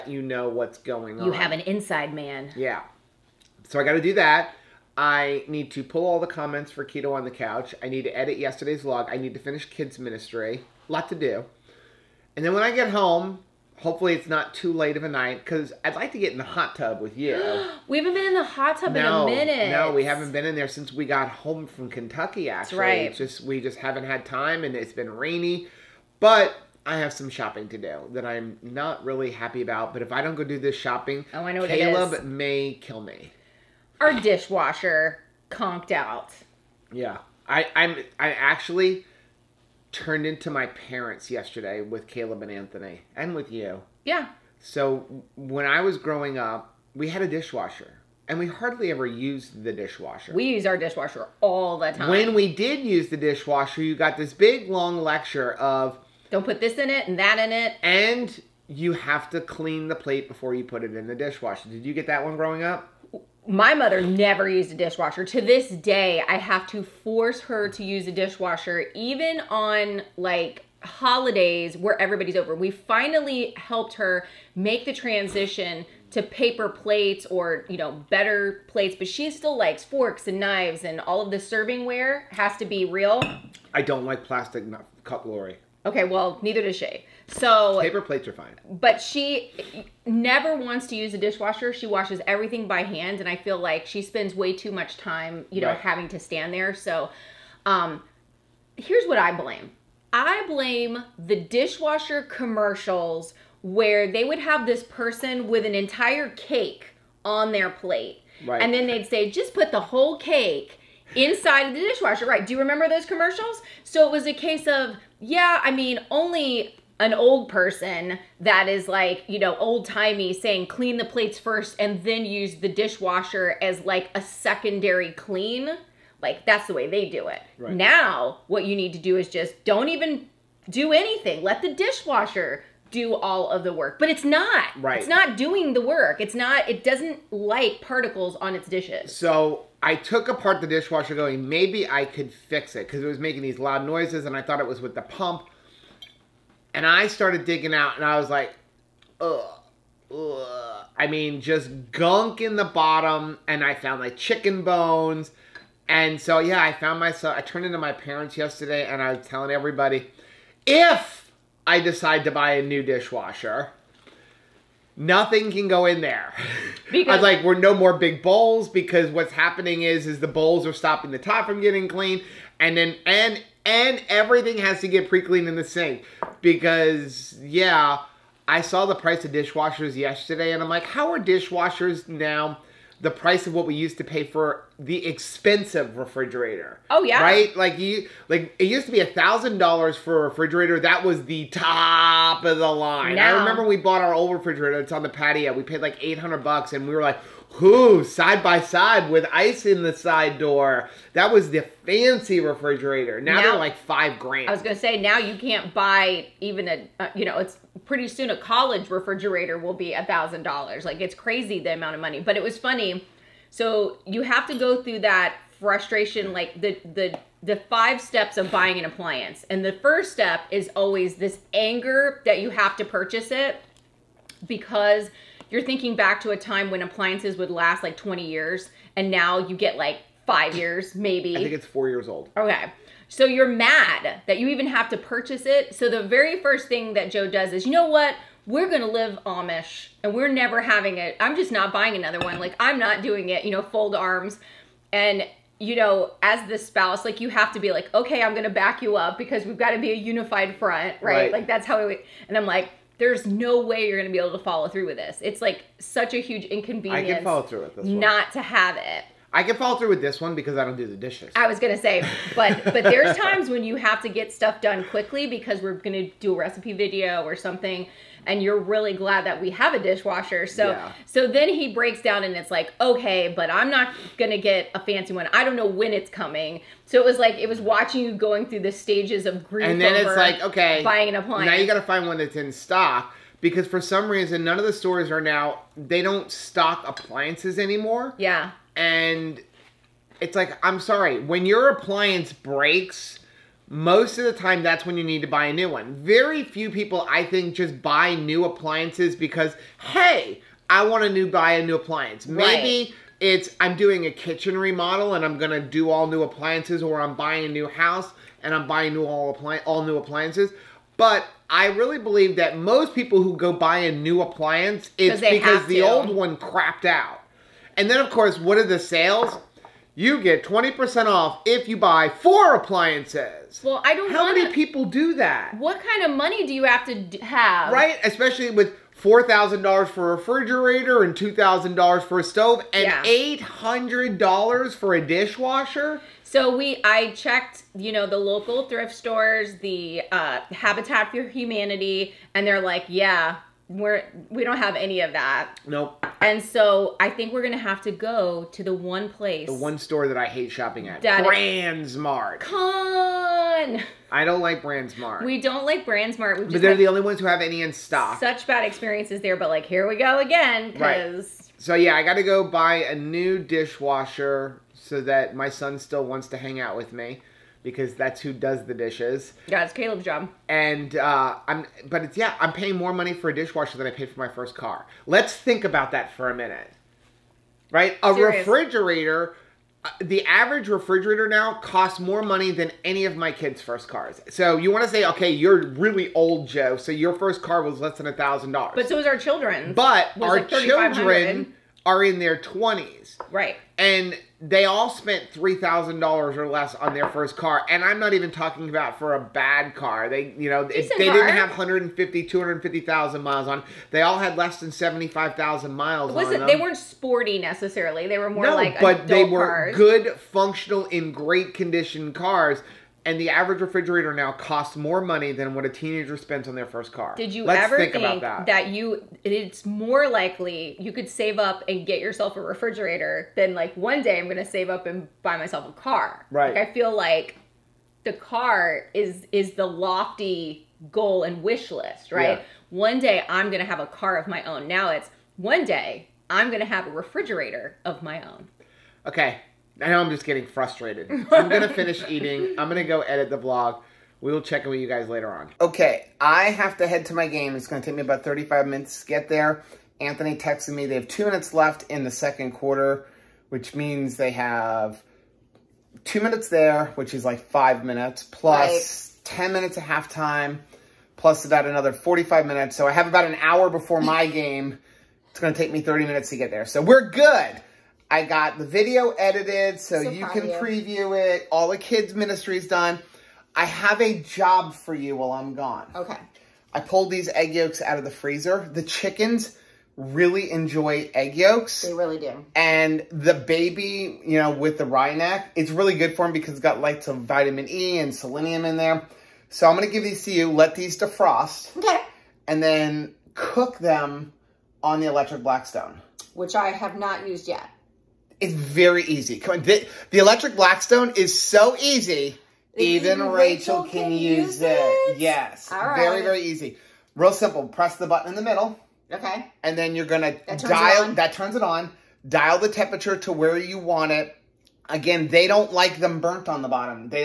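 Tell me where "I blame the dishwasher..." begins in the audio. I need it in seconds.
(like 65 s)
100 s.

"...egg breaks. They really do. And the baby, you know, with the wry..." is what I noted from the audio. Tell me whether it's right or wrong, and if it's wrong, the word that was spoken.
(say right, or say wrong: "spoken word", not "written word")
wrong: "yolks", not "breaks".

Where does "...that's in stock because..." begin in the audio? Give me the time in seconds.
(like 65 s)
282 s.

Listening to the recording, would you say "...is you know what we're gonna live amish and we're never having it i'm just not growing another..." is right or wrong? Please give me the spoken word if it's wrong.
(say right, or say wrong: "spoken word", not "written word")
wrong: "buying", not "growing".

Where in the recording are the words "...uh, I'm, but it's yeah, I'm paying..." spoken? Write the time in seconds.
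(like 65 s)
370 s.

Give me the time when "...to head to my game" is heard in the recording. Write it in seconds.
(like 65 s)
446 s.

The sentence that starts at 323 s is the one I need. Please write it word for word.
Well, I don't How wanna, many people do that?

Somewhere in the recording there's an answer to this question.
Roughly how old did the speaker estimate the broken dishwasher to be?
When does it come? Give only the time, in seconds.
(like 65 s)
231 s.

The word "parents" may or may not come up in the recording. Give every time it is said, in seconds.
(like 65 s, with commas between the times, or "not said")
40 s, 157 s.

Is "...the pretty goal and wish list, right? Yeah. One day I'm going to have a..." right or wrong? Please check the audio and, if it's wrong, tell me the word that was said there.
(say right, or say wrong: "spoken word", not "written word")
wrong: "lofty", not "pretty".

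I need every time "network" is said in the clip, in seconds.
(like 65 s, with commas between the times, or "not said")
not said.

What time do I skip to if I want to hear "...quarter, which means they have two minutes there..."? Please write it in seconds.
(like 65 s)
452 s.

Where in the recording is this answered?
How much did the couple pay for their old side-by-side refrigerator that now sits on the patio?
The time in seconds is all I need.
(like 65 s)
195 s.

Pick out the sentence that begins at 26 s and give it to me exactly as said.
But I have some shopping to do that I'm not really happy about.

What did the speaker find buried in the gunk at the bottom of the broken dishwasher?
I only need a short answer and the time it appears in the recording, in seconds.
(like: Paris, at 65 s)
Chicken bones, at 154 s.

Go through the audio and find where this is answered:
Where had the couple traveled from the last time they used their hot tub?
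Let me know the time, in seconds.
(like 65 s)
21 s.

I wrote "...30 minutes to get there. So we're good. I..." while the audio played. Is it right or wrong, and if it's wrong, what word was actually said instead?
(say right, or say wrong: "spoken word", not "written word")
right.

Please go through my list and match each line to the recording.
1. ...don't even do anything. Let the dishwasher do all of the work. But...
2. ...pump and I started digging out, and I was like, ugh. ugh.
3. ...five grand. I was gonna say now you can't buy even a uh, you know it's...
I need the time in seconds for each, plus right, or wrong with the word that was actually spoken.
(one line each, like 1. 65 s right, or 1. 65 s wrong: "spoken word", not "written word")
1. 129 s right
2. 145 s right
3. 203 s right.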